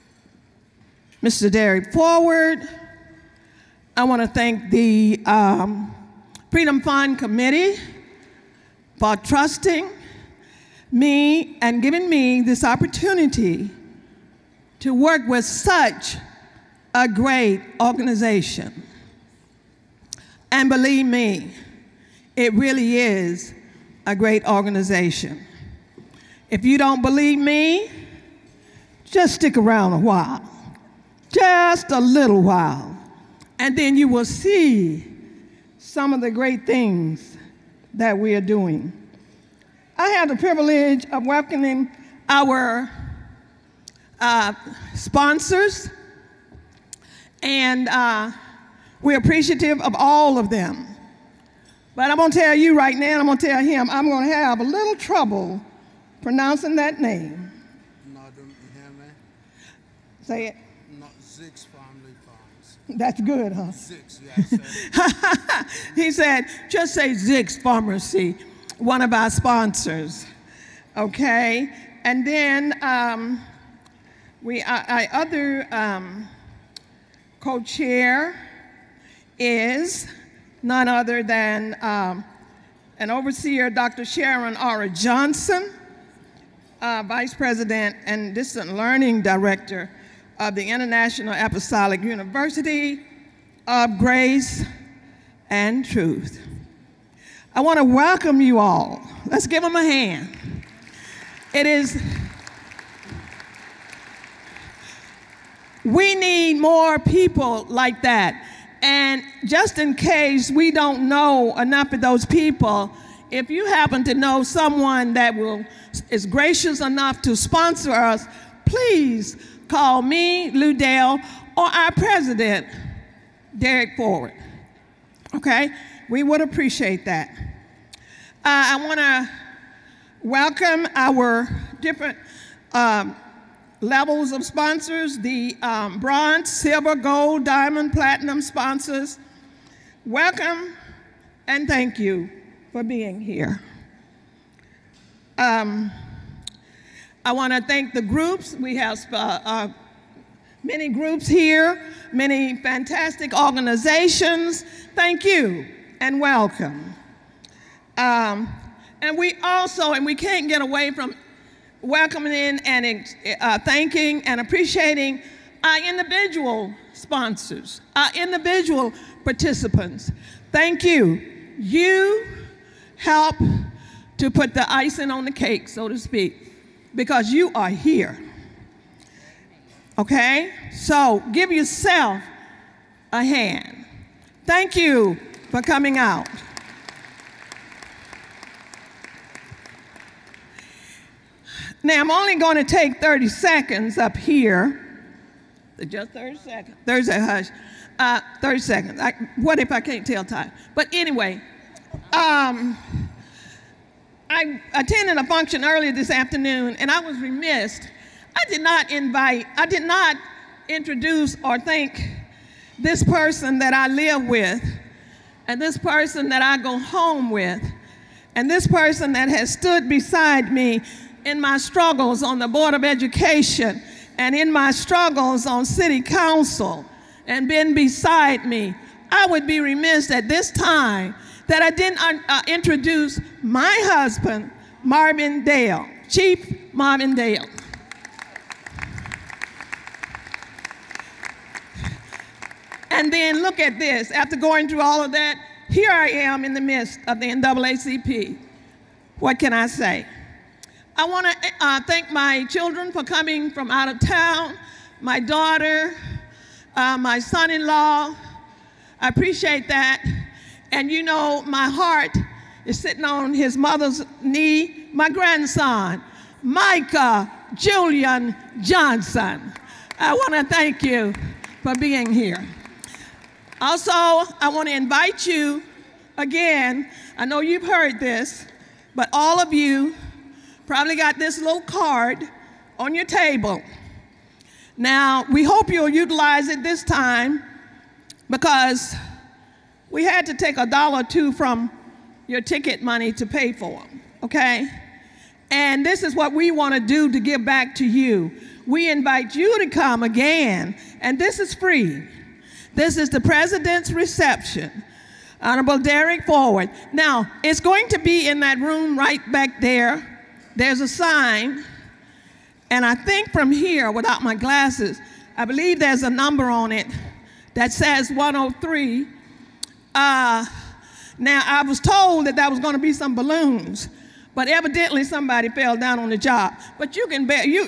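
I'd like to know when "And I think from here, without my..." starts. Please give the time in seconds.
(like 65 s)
312 s.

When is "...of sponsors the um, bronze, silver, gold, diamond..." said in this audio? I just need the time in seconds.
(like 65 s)
134 s.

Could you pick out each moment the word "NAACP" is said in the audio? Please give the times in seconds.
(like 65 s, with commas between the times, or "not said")
247 s.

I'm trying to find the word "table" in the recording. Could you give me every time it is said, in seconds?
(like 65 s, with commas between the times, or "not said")
283 s.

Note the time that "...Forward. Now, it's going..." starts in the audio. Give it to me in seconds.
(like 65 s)
306 s.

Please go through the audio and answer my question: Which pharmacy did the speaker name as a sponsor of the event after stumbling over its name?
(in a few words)
Zix Pharmacy.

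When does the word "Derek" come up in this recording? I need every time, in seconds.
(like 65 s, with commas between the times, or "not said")
1 s, 123 s, 305 s.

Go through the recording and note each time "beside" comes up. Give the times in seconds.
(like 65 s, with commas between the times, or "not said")
219 s, 227 s.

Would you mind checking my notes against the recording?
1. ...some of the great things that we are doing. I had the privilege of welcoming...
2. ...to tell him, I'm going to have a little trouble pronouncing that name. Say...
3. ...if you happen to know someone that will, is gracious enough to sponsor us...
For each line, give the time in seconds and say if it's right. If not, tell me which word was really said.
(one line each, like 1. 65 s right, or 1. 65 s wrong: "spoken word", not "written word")
1. 35 s right
2. 53 s right
3. 113 s right.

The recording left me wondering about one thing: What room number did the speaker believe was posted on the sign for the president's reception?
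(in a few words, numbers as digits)
103.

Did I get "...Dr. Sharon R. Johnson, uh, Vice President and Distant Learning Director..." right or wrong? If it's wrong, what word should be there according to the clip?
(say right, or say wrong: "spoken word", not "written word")
right.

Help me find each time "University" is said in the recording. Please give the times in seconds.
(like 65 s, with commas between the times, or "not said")
92 s.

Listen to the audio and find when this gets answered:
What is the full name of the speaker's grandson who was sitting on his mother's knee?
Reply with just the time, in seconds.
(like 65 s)
266 s.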